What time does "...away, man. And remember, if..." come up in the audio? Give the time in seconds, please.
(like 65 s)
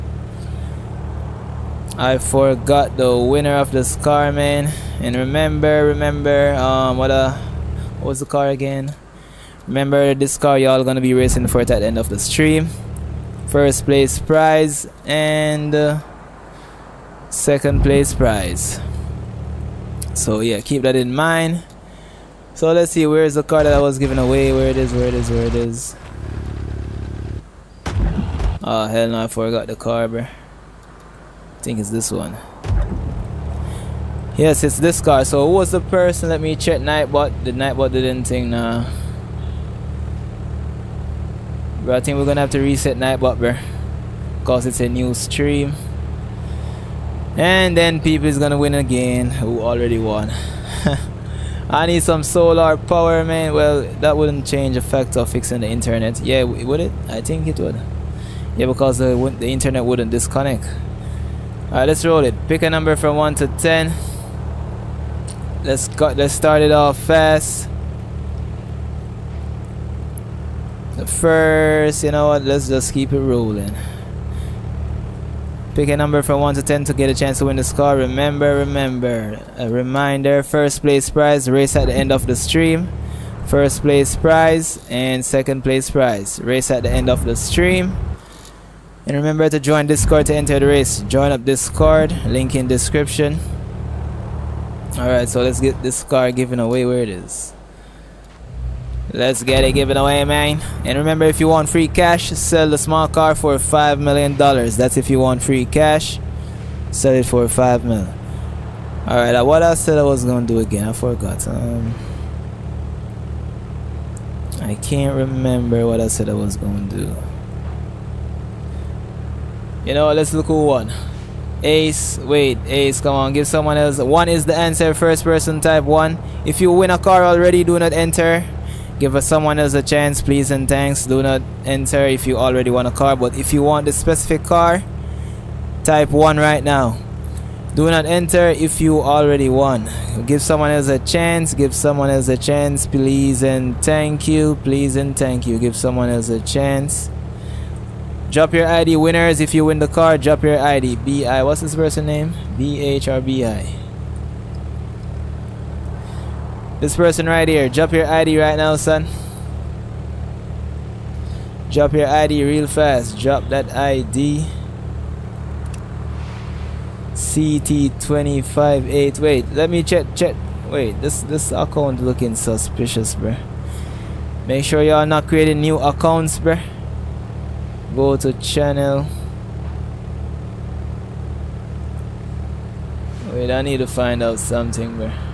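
99 s.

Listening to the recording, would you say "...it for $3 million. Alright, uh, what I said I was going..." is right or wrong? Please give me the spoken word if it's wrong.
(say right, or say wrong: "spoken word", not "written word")
wrong: "5", not "3".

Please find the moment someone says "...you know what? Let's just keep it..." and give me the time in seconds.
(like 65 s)
72 s.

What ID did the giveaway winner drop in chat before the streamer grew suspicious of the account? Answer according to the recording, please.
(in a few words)
CT258.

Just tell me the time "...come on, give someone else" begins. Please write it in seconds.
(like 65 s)
123 s.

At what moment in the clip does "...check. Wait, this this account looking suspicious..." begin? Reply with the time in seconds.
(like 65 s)
170 s.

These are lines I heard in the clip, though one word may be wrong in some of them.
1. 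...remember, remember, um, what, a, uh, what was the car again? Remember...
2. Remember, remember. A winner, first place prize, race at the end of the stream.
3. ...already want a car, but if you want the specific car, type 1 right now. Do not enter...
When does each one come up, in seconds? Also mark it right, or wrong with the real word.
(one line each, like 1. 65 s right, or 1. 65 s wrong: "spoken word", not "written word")
1. 5 s right
2. 77 s wrong: "reminder", not "winner"
3. 132 s right.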